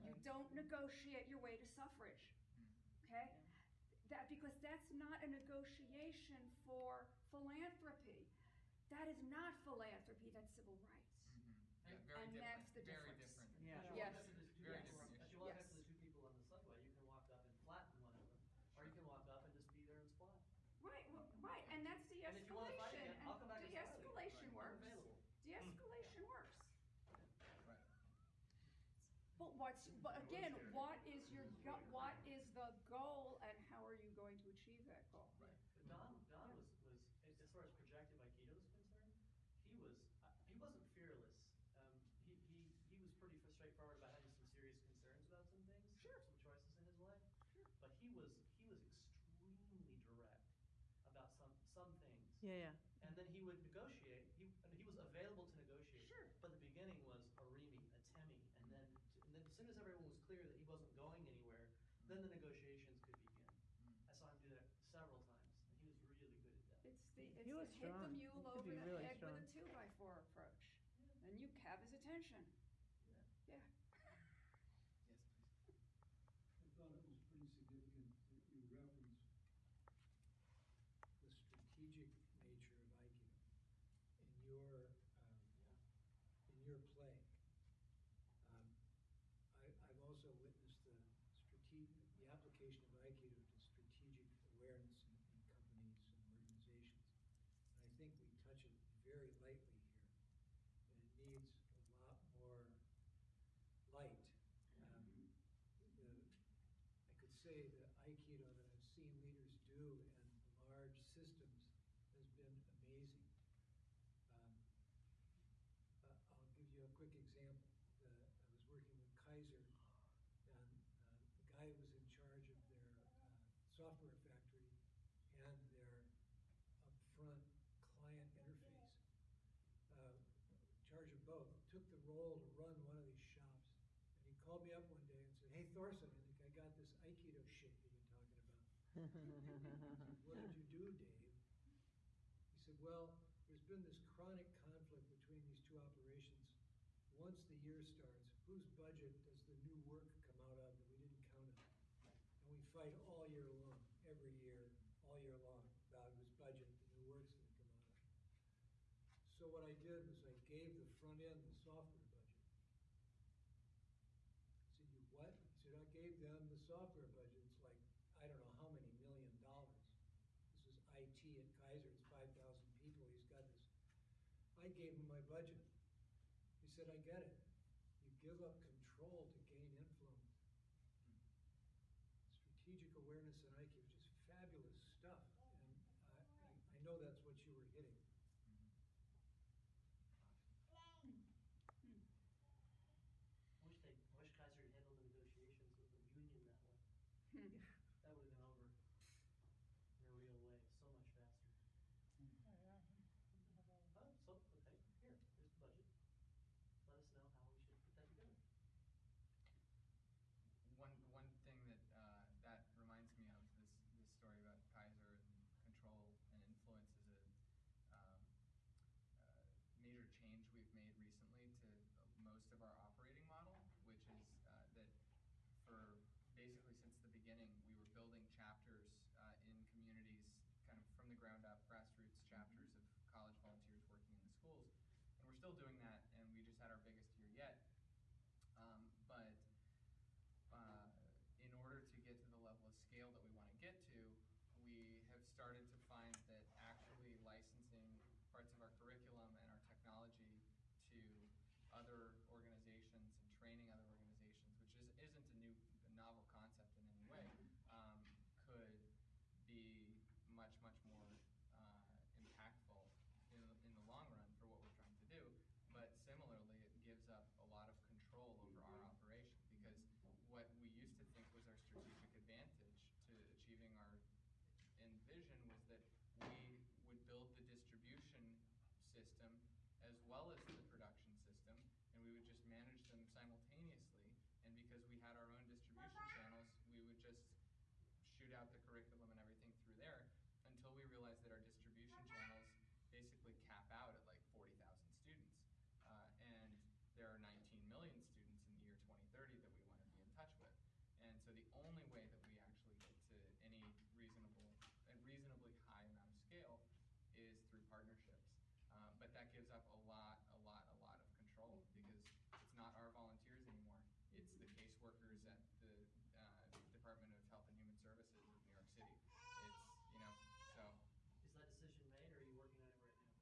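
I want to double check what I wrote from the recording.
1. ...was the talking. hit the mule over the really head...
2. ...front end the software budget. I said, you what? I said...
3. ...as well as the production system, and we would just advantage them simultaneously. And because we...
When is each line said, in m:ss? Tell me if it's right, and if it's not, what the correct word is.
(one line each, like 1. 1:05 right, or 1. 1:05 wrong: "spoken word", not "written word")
1. 1:07 wrong: "strong", not "talking"
2. 2:40 right
3. 4:39 wrong: "manage", not "advantage".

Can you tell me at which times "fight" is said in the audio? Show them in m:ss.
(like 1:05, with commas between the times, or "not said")
0:22, 2:32.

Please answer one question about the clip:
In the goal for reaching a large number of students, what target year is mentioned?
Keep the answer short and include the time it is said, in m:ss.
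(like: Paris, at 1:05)
2030, at 4:58.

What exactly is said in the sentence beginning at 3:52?
chapters of college volunteers working in the schools.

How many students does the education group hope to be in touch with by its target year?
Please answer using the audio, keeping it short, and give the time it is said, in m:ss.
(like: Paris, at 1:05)
19 million, at 4:57.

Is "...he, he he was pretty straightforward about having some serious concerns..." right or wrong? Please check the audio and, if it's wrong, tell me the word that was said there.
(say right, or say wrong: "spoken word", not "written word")
right.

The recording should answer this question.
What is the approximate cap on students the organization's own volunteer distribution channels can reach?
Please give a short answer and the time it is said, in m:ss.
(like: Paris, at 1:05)
40,000, at 4:54.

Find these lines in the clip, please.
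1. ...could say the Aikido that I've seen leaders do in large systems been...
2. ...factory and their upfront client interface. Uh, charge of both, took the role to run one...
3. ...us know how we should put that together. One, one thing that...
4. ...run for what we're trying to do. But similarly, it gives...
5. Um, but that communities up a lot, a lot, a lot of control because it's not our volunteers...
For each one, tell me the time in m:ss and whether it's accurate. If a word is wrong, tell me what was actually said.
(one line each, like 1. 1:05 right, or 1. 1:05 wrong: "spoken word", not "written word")
1. 1:47 right
2. 2:04 right
3. 3:26 right
4. 4:24 right
5. 5:08 wrong: "gives", not "communities".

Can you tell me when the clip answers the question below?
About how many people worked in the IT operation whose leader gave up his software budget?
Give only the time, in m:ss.
2:52.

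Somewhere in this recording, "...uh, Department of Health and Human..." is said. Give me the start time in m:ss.
5:16.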